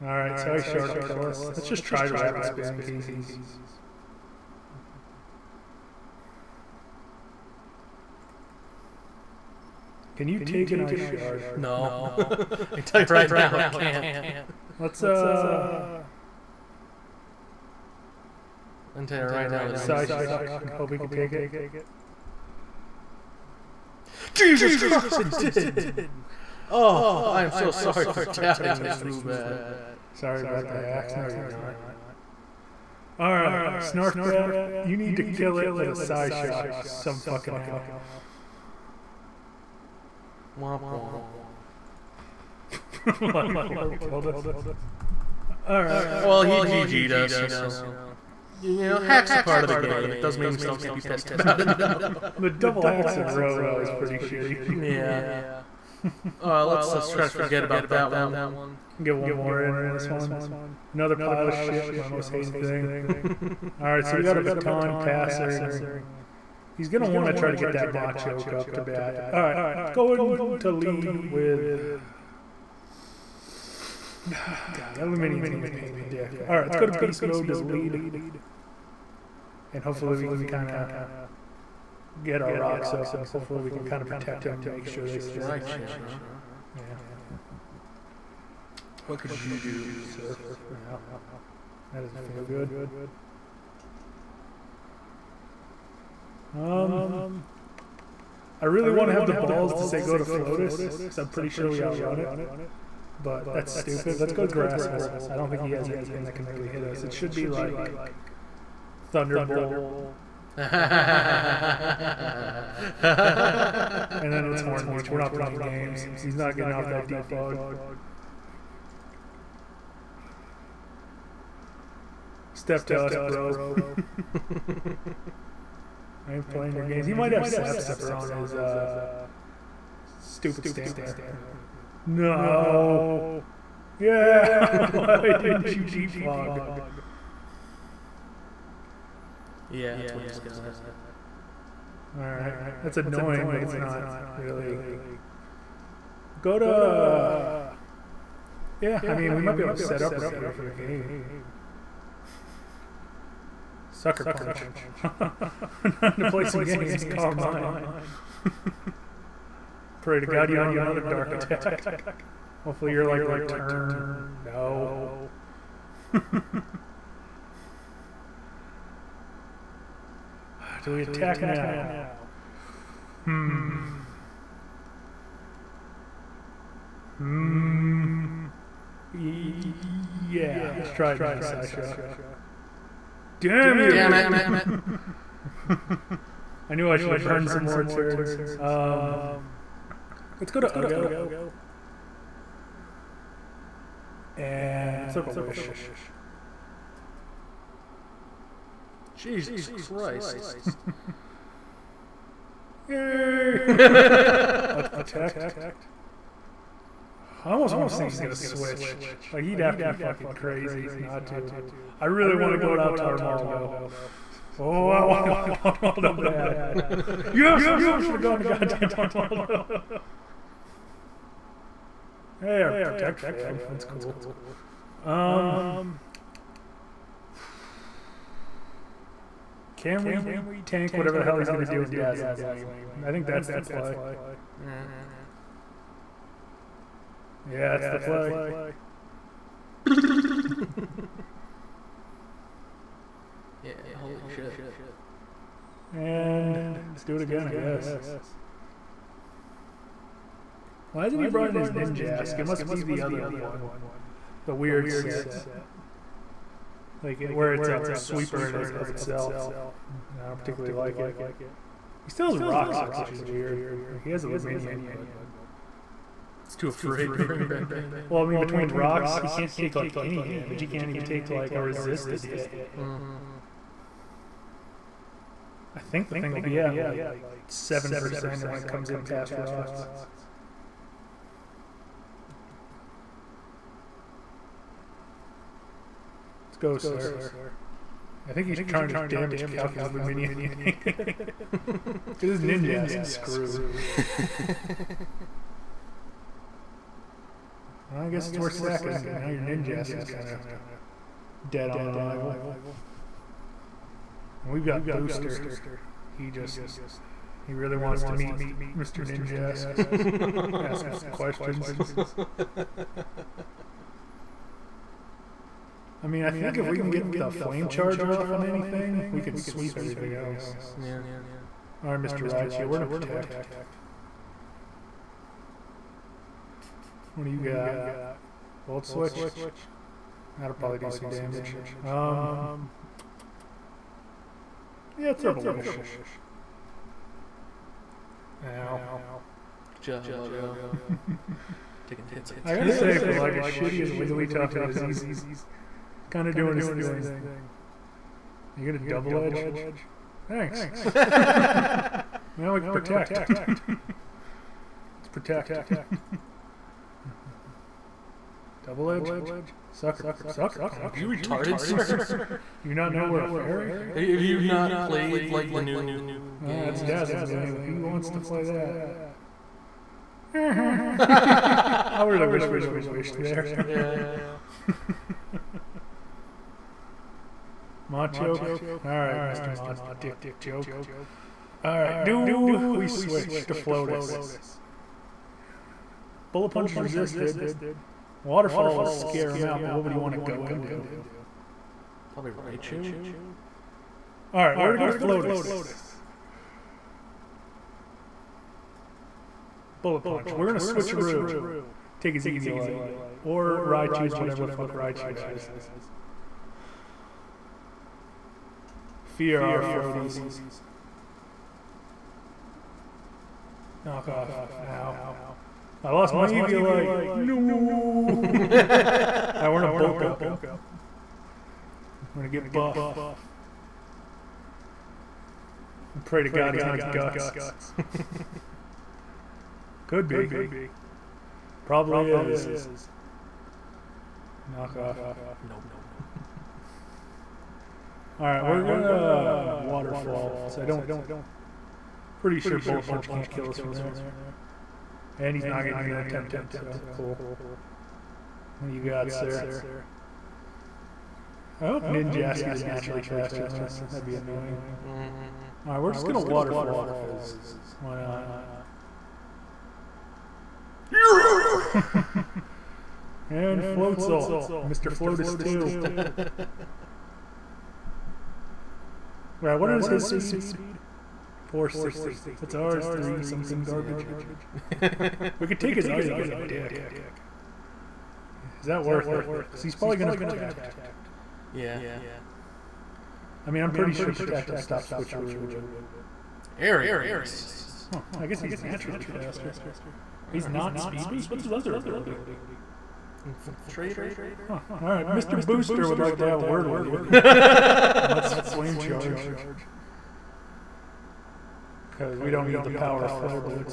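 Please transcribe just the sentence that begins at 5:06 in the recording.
He just, he really wants to meet Mr.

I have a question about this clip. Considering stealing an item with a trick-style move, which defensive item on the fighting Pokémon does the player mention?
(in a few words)
Eviolite.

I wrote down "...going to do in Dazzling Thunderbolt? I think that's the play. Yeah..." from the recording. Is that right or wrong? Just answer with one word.
wrong.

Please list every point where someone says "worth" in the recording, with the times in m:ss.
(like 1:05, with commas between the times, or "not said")
4:58, 7:58.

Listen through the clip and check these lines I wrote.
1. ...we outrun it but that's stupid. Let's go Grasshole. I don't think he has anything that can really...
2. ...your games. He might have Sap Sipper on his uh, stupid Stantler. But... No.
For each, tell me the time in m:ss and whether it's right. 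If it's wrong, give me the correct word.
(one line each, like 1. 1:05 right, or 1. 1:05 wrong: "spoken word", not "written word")
1. 1:41 right
2. 2:06 right.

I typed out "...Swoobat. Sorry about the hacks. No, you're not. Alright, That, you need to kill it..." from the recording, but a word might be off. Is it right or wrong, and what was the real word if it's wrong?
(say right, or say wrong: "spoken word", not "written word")
wrong: "Snarfbat", not "That".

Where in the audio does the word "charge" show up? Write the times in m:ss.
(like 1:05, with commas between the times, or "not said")
5:17, 8:18.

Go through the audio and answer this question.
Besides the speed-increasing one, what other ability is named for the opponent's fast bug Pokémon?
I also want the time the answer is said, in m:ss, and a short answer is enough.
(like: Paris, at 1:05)
Infiltrator, at 8:13.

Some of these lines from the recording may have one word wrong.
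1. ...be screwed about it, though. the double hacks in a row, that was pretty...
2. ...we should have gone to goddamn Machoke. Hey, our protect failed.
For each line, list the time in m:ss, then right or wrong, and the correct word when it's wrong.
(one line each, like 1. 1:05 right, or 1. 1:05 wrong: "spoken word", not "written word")
1. 0:50 wrong: "pissed", not "screwed"
2. 3:37 wrong: "Armaldo", not "Machoke".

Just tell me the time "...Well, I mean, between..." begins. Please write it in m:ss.
4:28.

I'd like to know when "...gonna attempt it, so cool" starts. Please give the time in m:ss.
7:25.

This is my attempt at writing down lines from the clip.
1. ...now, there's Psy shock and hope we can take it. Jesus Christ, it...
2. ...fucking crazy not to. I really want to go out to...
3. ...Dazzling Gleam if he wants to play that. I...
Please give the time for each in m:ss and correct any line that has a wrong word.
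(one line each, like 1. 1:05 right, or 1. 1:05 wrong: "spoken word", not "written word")
1. 0:19 right
2. 3:29 right
3. 6:06 right.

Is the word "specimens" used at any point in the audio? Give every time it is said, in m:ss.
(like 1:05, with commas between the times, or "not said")
not said.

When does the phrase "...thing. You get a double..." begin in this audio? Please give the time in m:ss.
5:46.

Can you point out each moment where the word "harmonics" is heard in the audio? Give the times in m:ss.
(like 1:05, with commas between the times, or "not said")
not said.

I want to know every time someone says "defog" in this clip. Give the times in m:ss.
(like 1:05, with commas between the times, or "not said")
1:57, 2:15.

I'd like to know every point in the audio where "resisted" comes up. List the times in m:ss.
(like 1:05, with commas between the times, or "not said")
4:31, 6:26.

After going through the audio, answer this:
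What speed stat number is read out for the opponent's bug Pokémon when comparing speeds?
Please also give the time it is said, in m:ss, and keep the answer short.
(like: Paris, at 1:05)
460, at 7:51.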